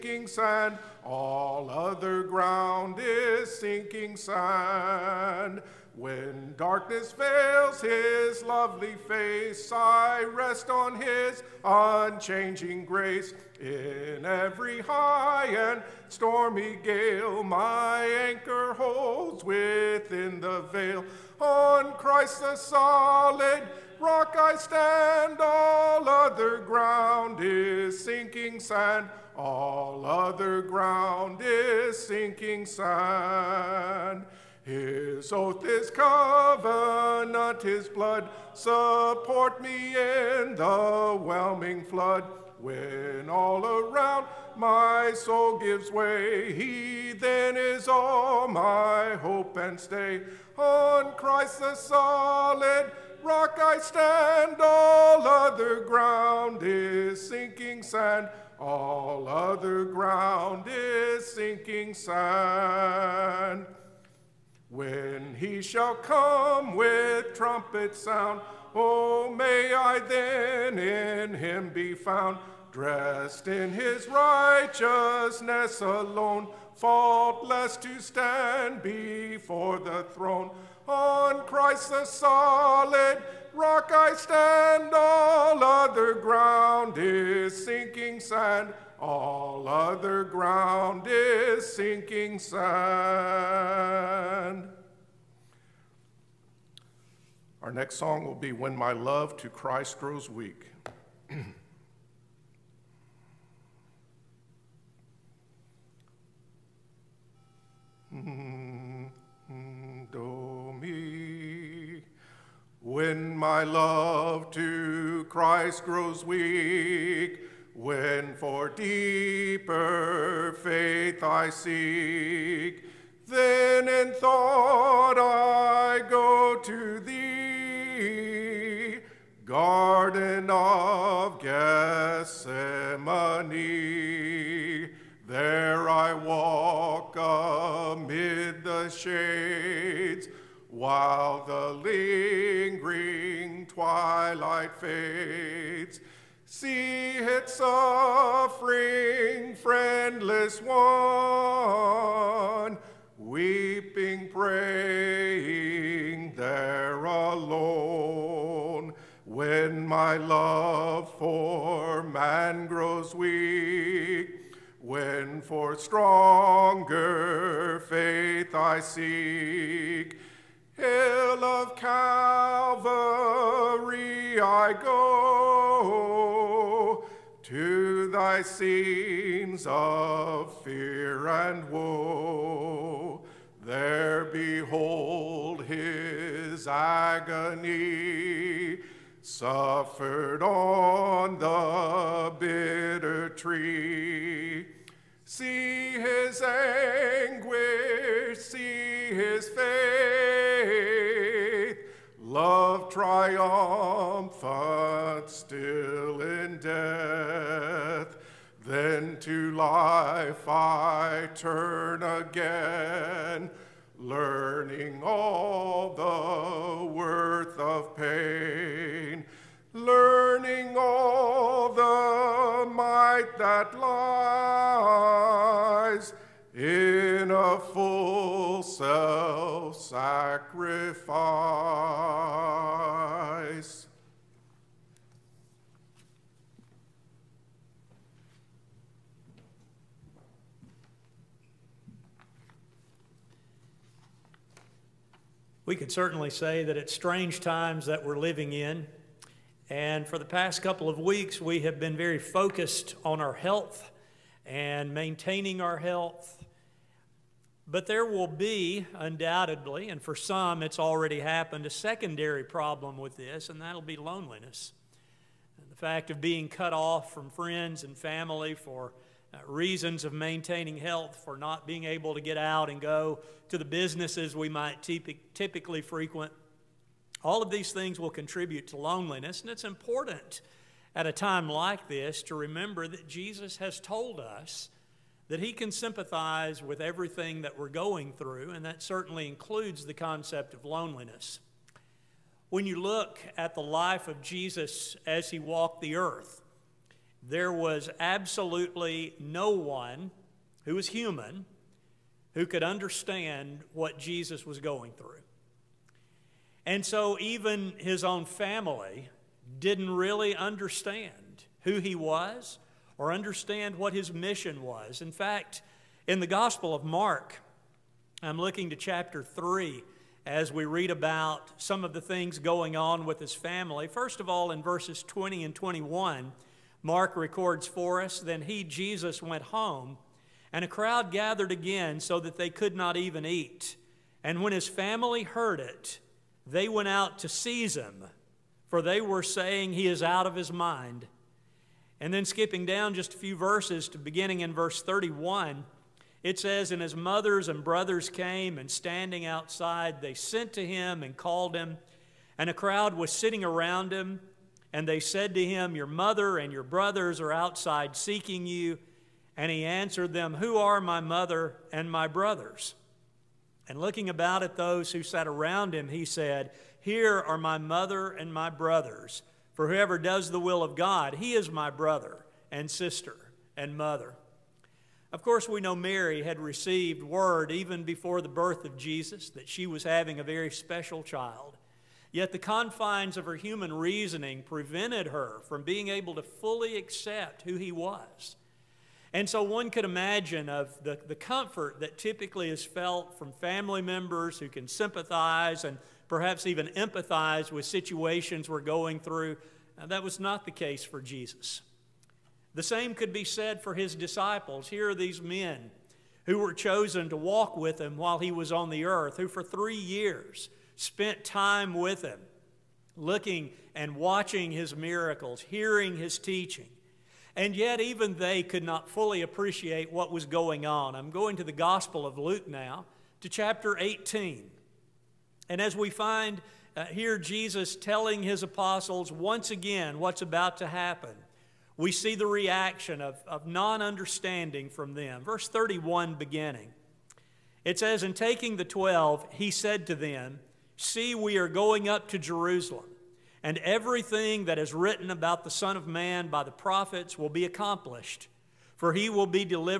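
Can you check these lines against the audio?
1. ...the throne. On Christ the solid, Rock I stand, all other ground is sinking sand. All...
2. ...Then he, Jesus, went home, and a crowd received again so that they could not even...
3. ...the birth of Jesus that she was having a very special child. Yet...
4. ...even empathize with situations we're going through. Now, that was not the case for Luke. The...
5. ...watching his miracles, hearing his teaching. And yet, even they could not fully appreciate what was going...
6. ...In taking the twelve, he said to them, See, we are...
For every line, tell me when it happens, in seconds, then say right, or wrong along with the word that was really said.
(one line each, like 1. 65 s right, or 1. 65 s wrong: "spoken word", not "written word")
1. 79 s right
2. 328 s wrong: "gathered", not "received"
3. 378 s right
4. 396 s wrong: "Jesus", not "Luke"
5. 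413 s right
6. 438 s right.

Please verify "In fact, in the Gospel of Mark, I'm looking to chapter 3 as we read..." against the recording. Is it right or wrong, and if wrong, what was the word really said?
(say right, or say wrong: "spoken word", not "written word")
right.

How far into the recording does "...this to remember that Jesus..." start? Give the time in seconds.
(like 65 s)
281 s.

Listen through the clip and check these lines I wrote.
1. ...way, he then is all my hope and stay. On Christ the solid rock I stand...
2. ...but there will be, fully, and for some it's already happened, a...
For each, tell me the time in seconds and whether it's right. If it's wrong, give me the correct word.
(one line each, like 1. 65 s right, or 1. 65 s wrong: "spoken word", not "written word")
1. 45 s right
2. 257 s wrong: "undoubtedly", not "fully".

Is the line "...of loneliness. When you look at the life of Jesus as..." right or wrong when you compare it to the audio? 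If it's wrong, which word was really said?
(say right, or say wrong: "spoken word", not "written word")
right.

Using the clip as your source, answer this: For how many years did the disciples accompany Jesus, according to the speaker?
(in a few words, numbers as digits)
3.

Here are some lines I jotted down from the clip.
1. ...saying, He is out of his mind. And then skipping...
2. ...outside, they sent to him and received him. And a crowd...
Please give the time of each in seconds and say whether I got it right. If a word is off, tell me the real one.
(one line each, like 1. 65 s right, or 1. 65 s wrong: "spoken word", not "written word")
1. 339 s right
2. 349 s wrong: "called", not "received".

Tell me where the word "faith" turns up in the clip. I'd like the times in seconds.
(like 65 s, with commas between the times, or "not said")
120 s, 167 s.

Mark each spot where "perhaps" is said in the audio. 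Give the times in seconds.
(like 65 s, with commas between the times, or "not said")
396 s.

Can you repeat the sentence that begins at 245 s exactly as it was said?
We could certainly say that it's strange times that we're living in.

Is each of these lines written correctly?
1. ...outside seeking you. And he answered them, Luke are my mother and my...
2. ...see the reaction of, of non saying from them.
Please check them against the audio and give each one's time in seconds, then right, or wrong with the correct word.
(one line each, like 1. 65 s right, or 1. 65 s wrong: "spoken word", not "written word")
1. 357 s wrong: "Who", not "Luke"
2. 431 s wrong: "understanding", not "saying".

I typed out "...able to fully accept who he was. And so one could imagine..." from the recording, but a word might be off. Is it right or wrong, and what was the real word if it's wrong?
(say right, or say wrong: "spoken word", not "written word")
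right.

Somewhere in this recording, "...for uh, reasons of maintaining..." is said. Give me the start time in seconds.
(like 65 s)
268 s.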